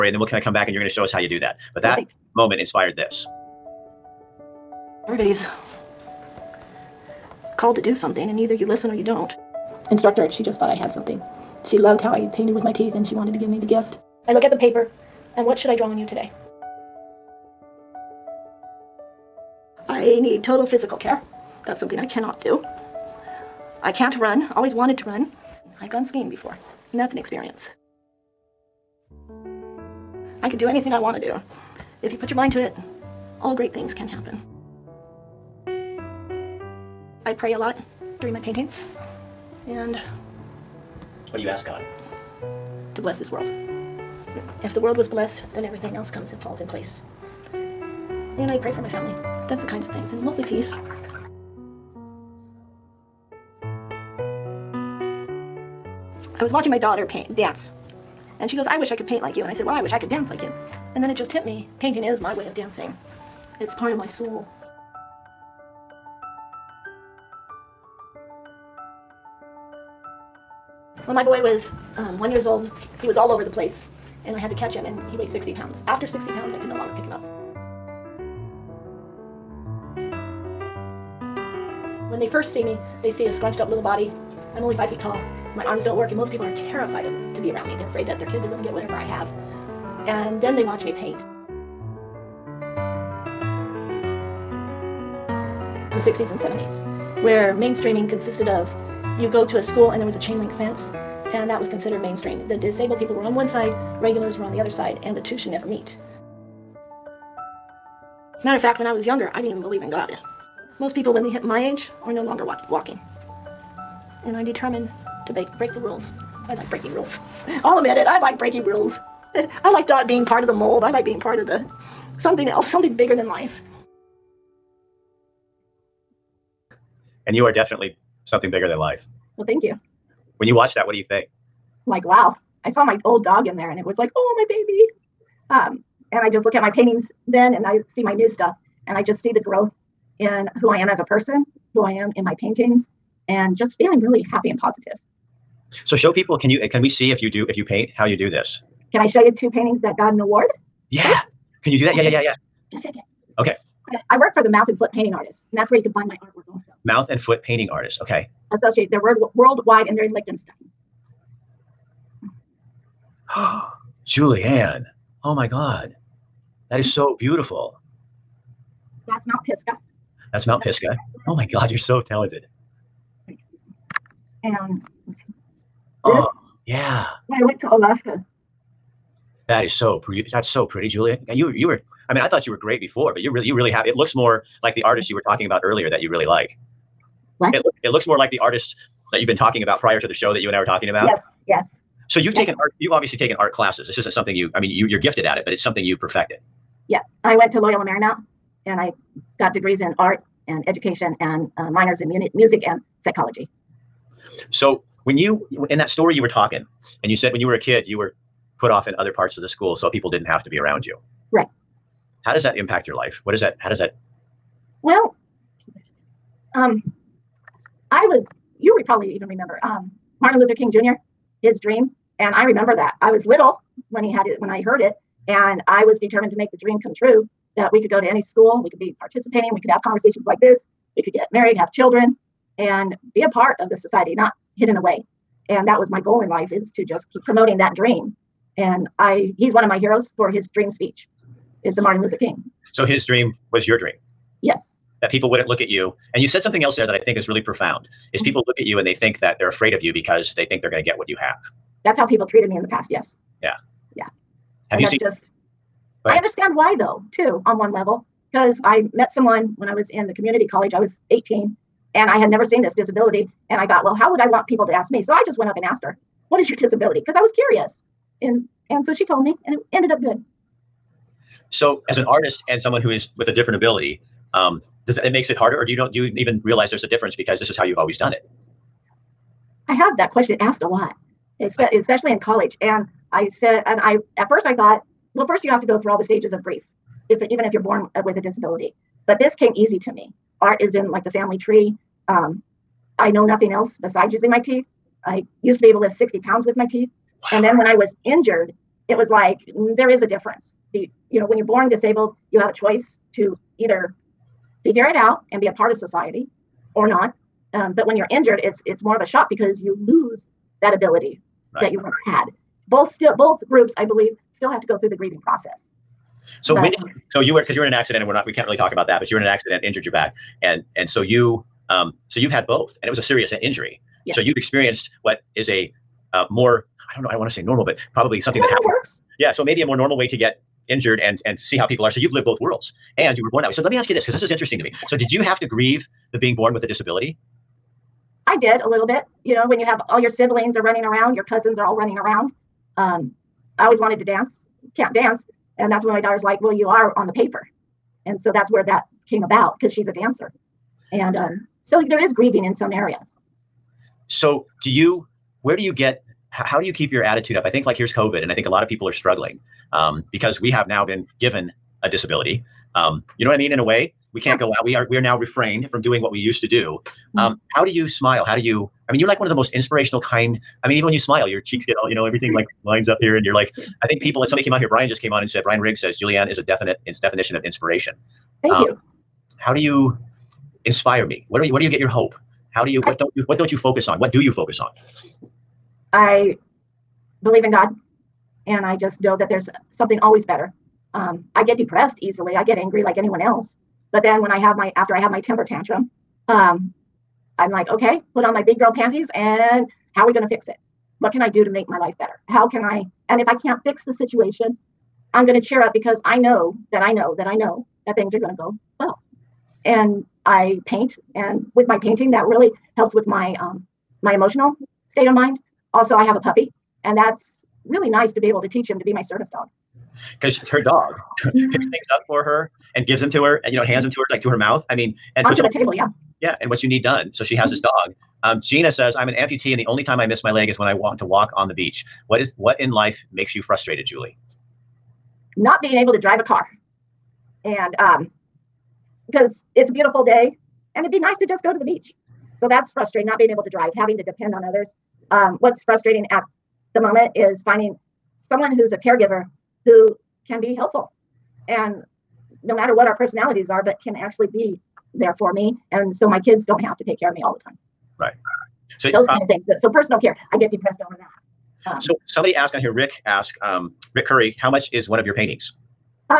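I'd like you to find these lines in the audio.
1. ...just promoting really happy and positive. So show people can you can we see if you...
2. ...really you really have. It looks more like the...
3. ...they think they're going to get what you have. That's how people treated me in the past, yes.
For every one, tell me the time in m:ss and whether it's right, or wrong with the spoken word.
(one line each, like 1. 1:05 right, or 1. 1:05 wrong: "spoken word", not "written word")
1. 2:23 wrong: "feeling", not "promoting"
2. 3:03 right
3. 4:10 right.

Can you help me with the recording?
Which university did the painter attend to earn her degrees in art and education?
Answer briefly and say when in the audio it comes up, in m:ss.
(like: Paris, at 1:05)
Loyola Marymount, at 3:17.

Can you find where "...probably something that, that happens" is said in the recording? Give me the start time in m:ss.
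5:27.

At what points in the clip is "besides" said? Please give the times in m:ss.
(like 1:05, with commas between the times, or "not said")
4:53.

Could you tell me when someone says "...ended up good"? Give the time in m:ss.
4:29.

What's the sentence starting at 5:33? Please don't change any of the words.
So let me ask you this because this is interesting to me.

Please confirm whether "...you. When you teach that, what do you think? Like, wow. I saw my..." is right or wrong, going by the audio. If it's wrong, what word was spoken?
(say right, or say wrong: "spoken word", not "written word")
wrong: "watch", not "teach".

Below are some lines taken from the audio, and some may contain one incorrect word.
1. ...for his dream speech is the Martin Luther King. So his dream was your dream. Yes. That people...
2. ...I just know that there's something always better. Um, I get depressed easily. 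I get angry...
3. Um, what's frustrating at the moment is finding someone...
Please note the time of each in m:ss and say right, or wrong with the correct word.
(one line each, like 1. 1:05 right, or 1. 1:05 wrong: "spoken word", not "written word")
1. 4:00 right
2. 6:28 right
3. 7:25 right.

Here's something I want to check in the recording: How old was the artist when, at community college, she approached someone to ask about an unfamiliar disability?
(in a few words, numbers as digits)
18.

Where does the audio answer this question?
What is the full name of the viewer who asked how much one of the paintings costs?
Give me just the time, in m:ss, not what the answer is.
7:43.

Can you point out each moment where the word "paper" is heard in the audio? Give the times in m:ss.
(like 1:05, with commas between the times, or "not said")
0:14, 5:47.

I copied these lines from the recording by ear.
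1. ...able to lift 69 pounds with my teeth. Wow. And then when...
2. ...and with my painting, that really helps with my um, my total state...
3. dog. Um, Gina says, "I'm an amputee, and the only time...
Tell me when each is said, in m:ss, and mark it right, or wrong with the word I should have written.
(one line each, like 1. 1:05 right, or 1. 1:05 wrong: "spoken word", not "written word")
1. 4:55 wrong: "60", not "69"
2. 6:51 wrong: "emotional", not "total"
3. 7:07 right.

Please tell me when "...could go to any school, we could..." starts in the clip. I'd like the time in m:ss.
3:47.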